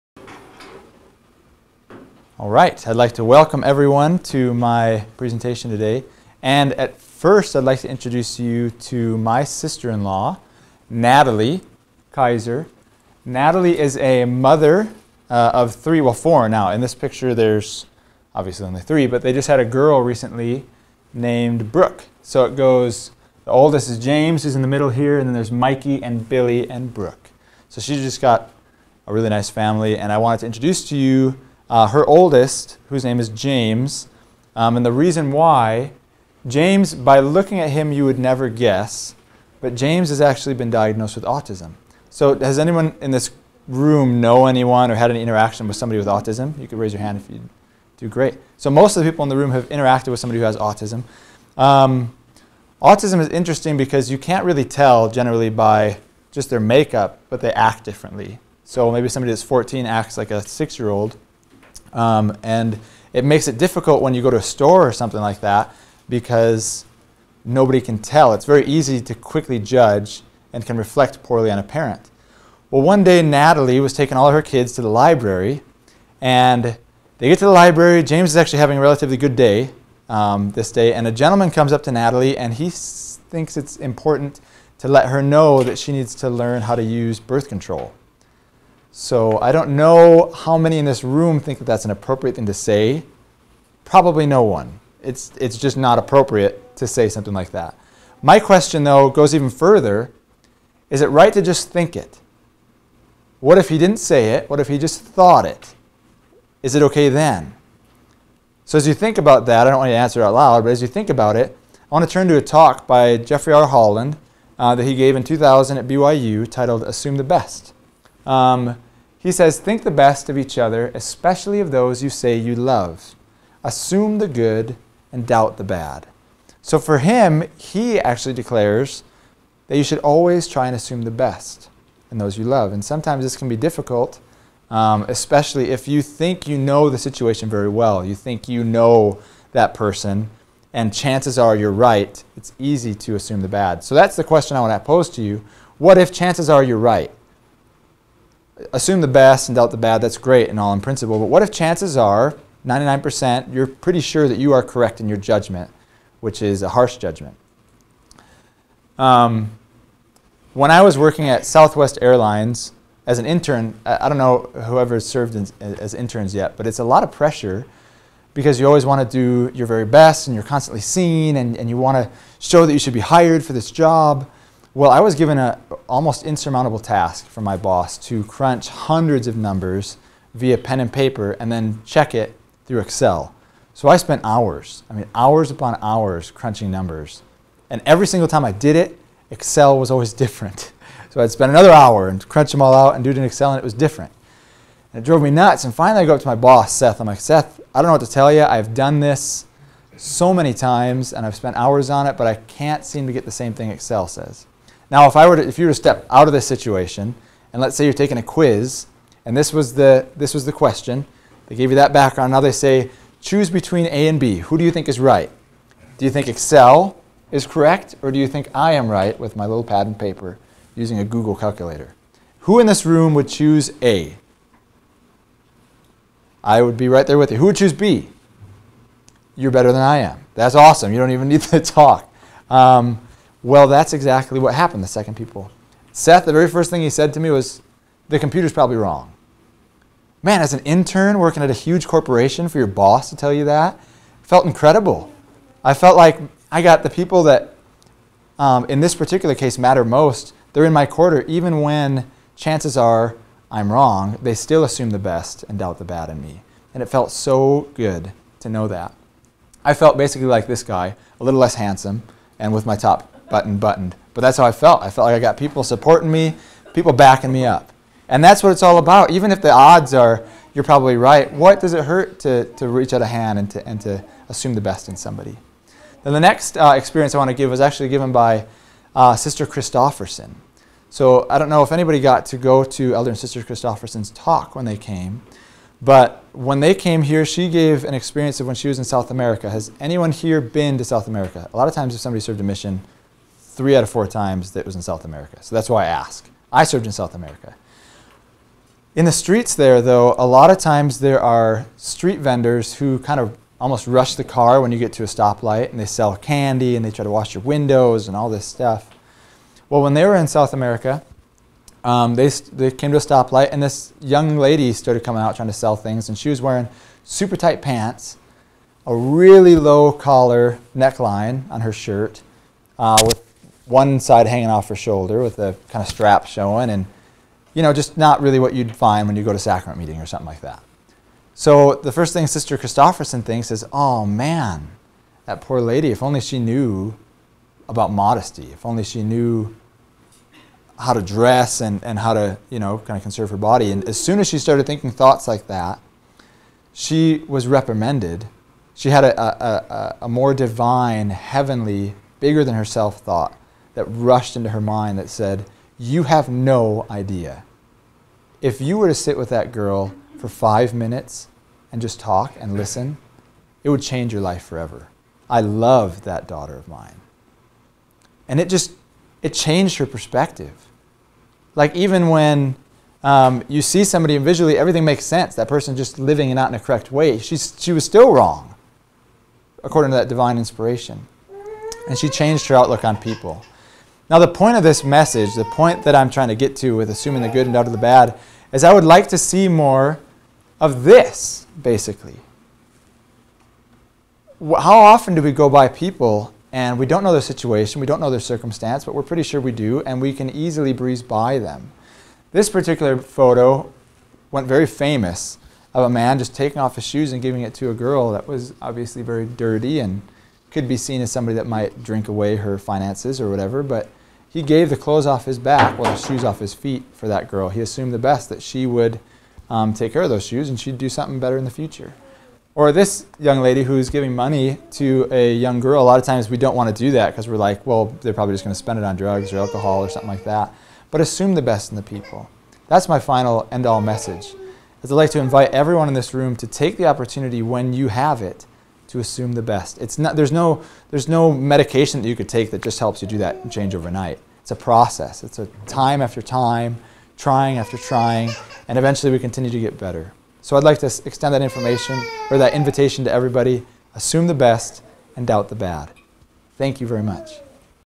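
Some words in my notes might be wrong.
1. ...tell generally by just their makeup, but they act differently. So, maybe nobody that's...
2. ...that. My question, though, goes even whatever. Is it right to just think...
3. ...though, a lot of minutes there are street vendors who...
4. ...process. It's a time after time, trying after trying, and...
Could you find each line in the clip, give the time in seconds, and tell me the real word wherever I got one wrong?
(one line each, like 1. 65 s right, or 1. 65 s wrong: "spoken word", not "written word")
1. 54 s wrong: "somebody", not "nobody"
2. 97 s wrong: "further", not "whatever"
3. 299 s wrong: "times", not "minutes"
4. 444 s right.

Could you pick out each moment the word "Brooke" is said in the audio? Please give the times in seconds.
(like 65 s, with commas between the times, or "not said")
21 s, 26 s.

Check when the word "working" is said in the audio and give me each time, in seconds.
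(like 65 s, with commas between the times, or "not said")
160 s, 241 s.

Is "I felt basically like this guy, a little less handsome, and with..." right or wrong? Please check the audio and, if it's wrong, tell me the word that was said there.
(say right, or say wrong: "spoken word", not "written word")
right.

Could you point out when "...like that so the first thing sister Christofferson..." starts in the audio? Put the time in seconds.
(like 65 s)
330 s.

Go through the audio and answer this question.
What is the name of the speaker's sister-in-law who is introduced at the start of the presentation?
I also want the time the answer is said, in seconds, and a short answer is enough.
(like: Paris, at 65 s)
Natalie Kaiser, at 10 s.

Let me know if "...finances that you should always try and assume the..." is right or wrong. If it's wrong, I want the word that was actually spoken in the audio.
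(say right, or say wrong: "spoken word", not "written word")
wrong: "declares", not "finances".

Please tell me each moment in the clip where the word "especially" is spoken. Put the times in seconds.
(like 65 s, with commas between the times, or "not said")
120 s, 135 s.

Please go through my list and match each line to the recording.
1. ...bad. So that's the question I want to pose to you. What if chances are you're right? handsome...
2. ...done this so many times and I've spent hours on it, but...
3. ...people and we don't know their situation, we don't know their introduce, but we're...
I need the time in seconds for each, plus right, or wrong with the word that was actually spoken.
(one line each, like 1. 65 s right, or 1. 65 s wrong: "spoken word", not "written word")
1. 143 s wrong: "assume", not "handsome"
2. 198 s right
3. 395 s wrong: "circumstance", not "introduce".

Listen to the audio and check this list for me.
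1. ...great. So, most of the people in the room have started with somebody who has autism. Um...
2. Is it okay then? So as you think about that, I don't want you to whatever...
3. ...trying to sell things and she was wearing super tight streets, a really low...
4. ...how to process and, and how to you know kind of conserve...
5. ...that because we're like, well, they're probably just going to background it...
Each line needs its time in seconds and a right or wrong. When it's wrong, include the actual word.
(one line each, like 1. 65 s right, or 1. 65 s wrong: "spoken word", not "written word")
1. 48 s wrong: "interacted", not "started"
2. 106 s wrong: "answer", not "whatever"
3. 315 s wrong: "pants", not "streets"
4. 340 s wrong: "dress", not "process"
5. 426 s wrong: "spend", not "background".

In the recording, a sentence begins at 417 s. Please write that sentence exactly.
He assumed the best that she would um, take care of those shoes and she'd do something better in the future.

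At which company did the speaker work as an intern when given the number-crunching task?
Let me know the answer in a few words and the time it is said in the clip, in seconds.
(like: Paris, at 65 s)
Southwest Airlines, at 161 s.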